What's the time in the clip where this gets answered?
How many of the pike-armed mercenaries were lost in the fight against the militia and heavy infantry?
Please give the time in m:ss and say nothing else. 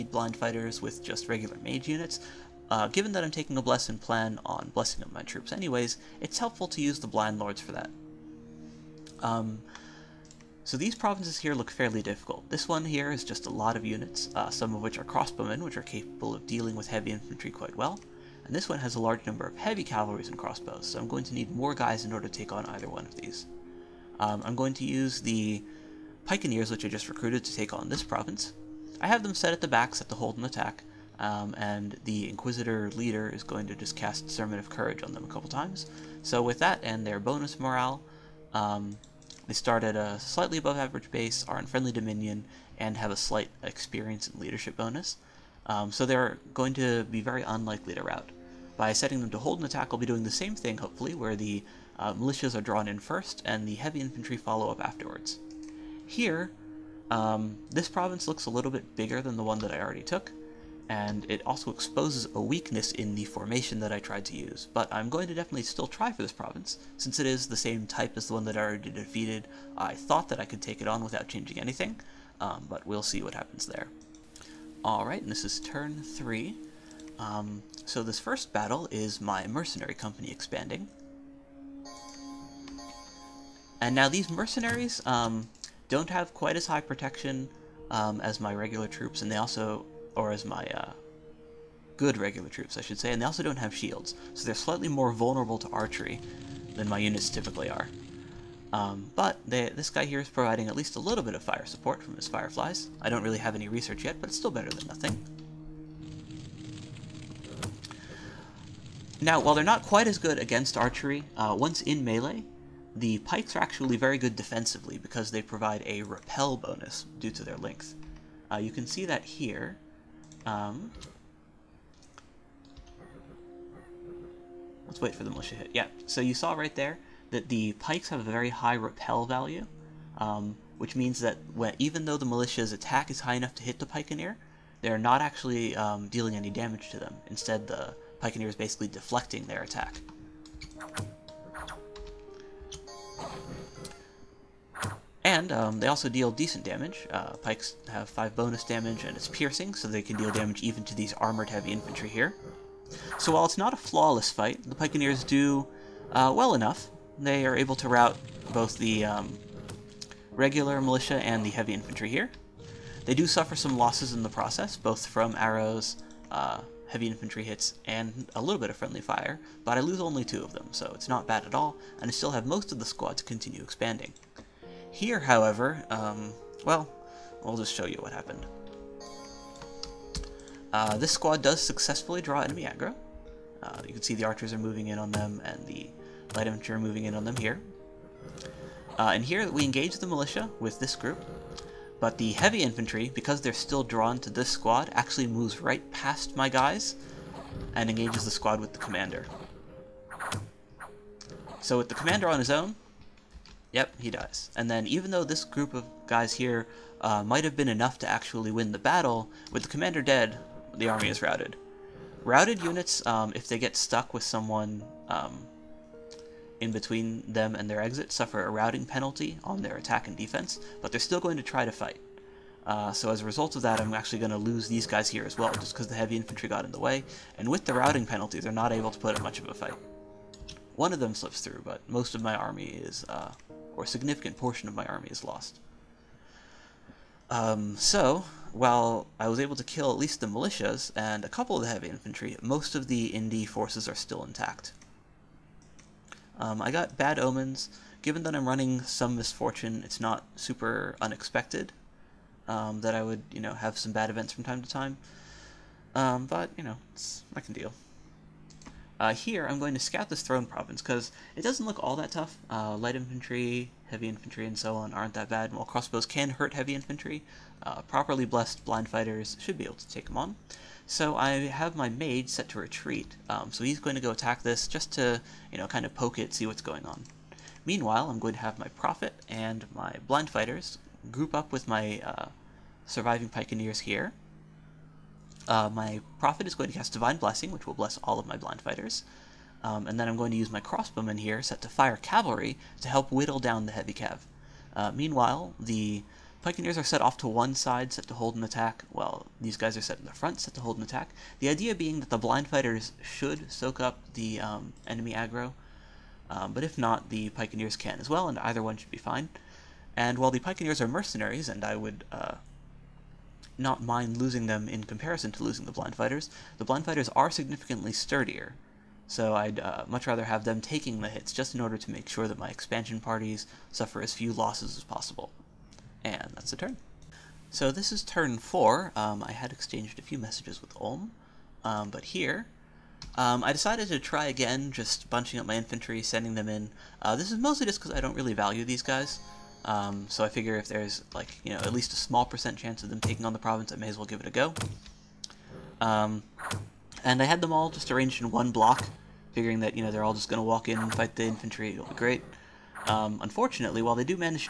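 2:50.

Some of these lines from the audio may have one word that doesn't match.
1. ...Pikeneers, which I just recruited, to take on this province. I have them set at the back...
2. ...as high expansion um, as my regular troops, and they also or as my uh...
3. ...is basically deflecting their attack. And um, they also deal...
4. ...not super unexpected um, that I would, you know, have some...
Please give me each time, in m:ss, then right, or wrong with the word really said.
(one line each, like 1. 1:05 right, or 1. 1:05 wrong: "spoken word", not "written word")
1. 0:26 right
2. 1:26 wrong: "protection", not "expansion"
3. 2:18 right
4. 4:09 right.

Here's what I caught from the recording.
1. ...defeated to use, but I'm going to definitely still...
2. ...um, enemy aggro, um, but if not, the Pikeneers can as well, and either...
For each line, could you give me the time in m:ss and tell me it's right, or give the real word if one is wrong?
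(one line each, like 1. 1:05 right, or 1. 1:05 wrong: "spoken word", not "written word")
1. 1:03 wrong: "tried", not "defeated"
2. 5:04 right.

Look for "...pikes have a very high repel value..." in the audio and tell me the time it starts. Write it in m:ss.
2:07.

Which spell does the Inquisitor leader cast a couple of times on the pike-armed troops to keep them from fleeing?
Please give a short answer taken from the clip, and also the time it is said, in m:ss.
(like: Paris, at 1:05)
Sermon of Courage, at 0:34.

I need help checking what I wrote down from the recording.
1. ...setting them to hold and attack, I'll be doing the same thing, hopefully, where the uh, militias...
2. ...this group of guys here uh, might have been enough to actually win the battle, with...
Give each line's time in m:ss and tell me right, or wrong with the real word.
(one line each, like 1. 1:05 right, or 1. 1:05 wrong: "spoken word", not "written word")
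1. 0:48 right
2. 3:25 right.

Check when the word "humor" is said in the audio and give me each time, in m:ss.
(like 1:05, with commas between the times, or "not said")
not said.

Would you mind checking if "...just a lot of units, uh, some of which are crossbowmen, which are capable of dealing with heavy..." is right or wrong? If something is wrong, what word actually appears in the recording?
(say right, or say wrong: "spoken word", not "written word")
right.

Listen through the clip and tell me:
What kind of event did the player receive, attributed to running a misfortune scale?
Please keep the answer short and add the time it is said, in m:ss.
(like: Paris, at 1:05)
Bad omens, at 4:06.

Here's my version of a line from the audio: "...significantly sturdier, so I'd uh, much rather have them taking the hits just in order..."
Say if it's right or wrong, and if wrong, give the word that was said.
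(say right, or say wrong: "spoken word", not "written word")
right.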